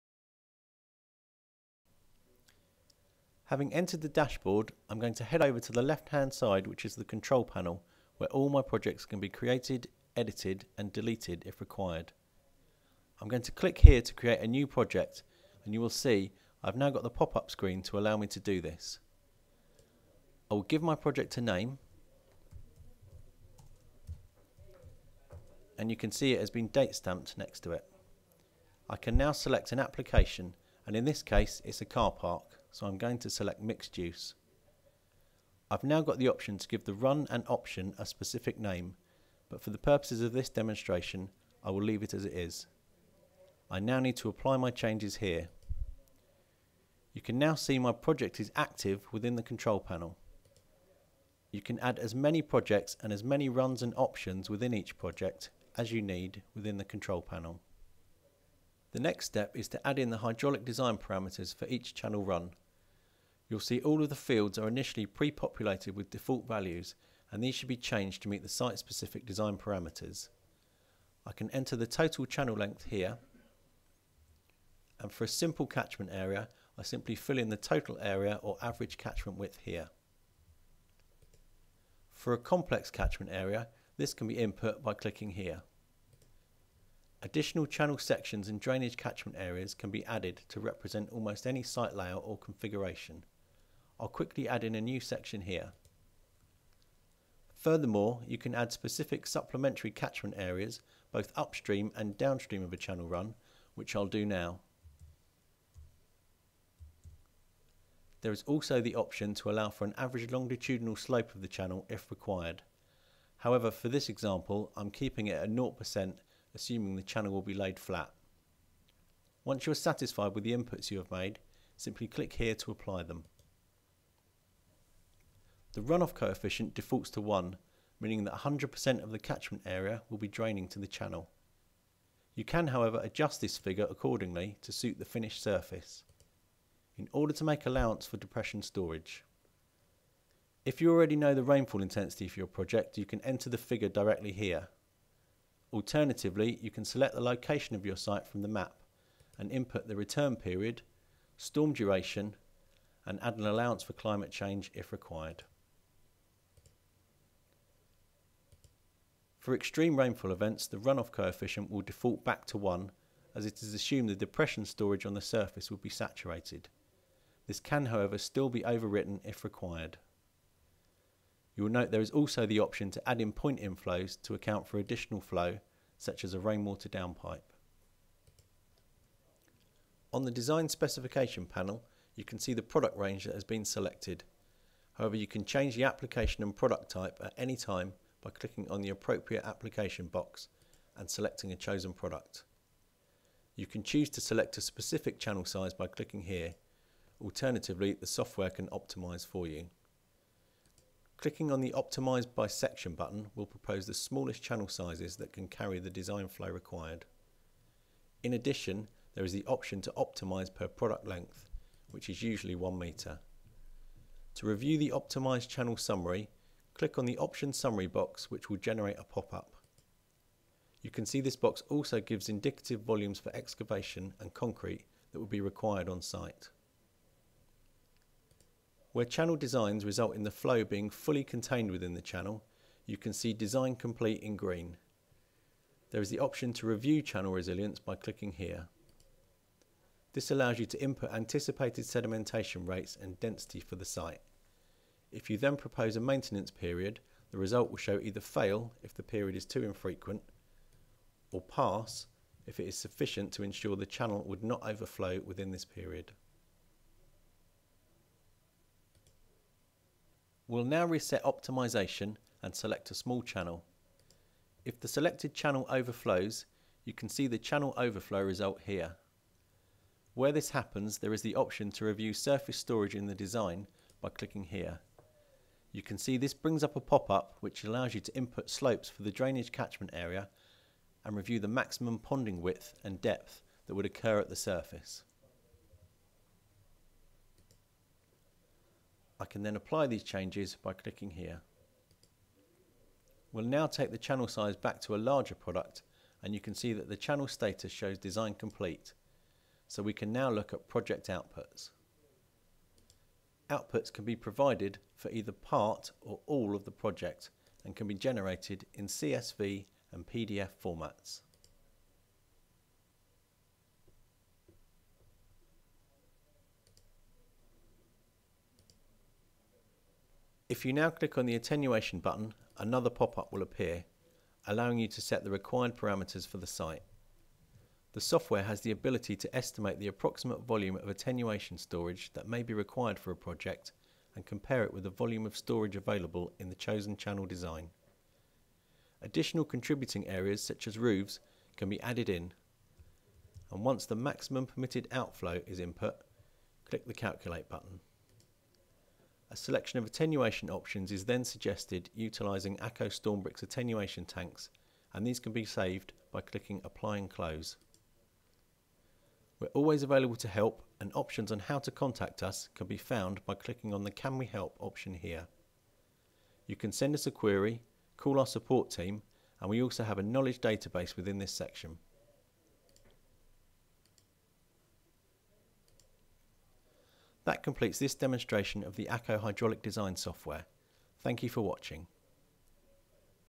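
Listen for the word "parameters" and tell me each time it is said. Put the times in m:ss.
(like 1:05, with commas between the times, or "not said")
1:00, 1:09, 5:25.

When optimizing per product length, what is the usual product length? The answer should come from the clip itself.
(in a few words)
1 meter.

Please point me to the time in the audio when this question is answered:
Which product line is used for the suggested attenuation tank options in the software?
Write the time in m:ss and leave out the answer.
5:52.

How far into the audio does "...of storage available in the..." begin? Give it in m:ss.
5:35.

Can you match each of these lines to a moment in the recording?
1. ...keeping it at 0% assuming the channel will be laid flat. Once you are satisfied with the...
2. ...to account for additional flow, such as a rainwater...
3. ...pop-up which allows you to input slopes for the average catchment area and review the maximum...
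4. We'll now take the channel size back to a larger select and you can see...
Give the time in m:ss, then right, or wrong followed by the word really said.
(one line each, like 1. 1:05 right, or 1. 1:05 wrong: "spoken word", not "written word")
1. 1:54 right
2. 2:54 right
3. 4:36 wrong: "drainage", not "average"
4. 4:53 wrong: "product", not "select".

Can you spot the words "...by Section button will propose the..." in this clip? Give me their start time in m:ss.
3:22.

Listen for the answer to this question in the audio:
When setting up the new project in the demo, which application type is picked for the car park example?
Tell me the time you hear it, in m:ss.
0:33.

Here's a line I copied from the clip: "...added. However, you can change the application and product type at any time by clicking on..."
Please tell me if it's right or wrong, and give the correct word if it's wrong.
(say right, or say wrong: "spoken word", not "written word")
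wrong: "selected", not "added".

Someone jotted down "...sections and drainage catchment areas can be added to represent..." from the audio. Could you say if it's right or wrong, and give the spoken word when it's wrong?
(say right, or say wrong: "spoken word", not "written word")
right.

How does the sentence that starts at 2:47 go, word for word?
This can, however, still be overwritten if required.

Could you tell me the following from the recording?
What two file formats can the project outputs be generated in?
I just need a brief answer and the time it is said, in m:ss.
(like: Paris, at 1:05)
CSV and PDF, at 5:08.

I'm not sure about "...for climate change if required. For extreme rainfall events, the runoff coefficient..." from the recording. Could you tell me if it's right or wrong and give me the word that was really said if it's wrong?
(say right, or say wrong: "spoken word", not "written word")
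right.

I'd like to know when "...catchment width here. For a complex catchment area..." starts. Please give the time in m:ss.
1:18.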